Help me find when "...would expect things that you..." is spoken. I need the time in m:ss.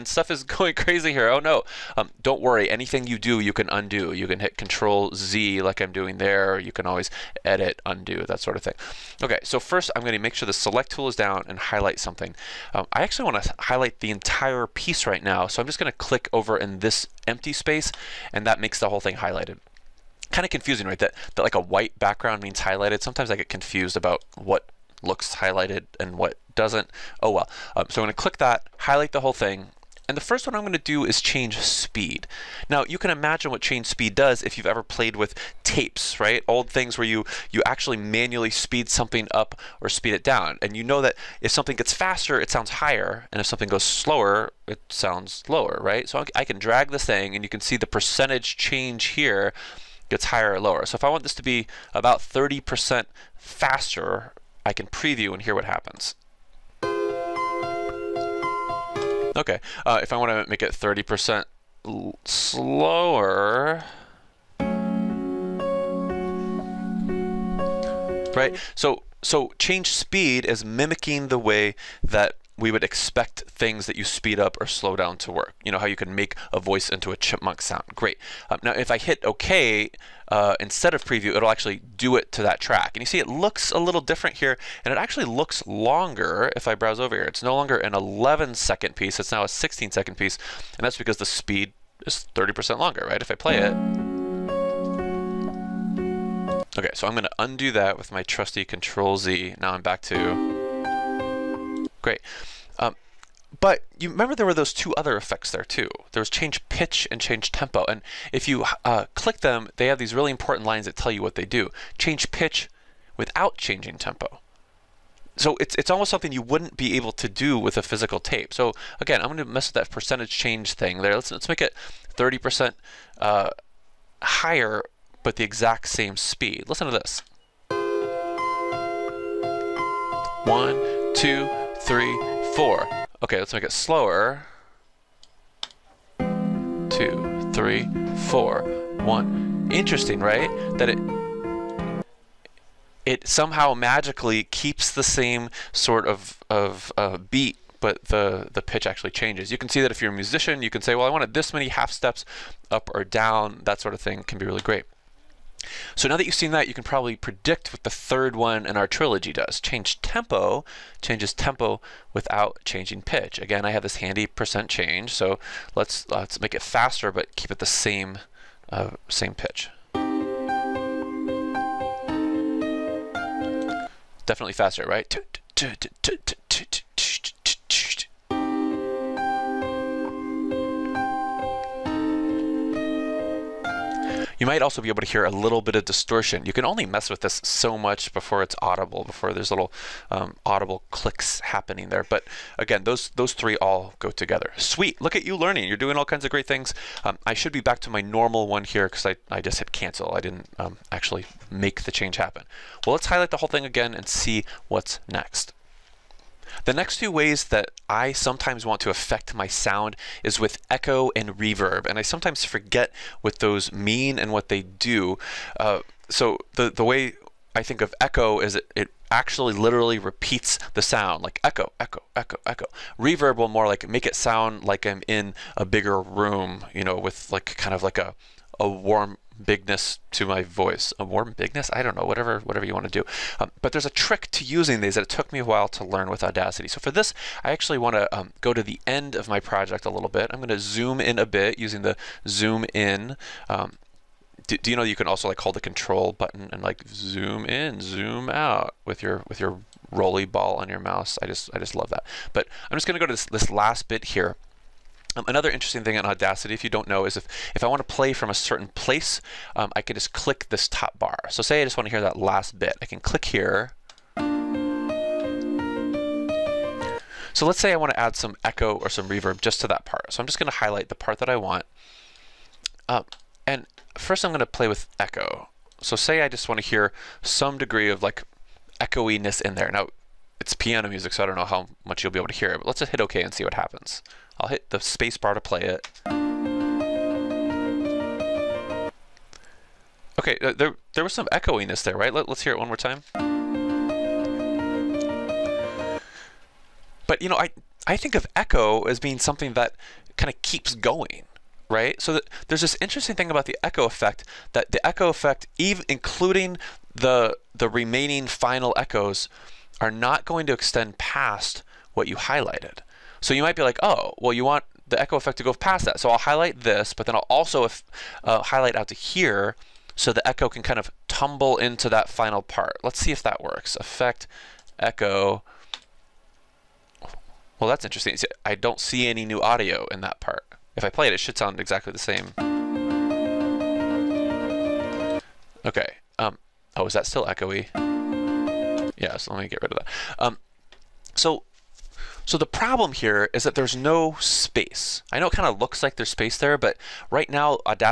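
1:12.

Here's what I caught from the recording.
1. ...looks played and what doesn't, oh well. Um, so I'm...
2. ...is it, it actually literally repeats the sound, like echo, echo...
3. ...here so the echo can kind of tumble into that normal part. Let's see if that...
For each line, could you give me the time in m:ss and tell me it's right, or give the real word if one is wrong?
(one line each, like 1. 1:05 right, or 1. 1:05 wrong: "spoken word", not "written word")
1. 0:25 wrong: "highlighted", not "played"
2. 3:38 right
3. 5:18 wrong: "final", not "normal".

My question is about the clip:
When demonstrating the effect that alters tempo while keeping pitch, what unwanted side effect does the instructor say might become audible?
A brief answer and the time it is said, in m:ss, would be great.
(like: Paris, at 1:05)
distortion, at 3:05.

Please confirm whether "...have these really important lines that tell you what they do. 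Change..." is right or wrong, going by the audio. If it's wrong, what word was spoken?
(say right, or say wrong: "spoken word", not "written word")
right.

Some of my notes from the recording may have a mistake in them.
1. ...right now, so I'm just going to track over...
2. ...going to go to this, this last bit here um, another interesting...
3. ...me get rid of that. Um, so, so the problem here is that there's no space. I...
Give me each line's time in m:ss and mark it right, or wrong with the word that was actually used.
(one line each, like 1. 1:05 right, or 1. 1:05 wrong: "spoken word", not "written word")
1. 0:15 wrong: "click", not "track"
2. 4:12 right
3. 5:39 right.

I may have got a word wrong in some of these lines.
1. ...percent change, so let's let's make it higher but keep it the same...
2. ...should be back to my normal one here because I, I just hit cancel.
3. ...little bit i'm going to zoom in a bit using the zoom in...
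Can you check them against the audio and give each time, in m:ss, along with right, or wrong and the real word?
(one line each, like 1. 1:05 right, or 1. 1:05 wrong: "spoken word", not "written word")
1. 2:44 wrong: "faster", not "higher"
2. 3:17 right
3. 3:59 right.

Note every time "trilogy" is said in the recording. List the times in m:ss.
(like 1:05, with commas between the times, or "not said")
2:38.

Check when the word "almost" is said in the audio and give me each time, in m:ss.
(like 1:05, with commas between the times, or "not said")
1:55.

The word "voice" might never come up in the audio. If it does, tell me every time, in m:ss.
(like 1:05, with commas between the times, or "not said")
1:16, 3:50.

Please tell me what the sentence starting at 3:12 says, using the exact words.
But again, those, those three all go together.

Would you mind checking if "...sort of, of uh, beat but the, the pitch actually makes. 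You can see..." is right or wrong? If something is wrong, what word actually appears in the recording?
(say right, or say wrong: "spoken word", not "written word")
wrong: "changes", not "makes".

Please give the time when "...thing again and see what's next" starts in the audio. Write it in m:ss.
3:23.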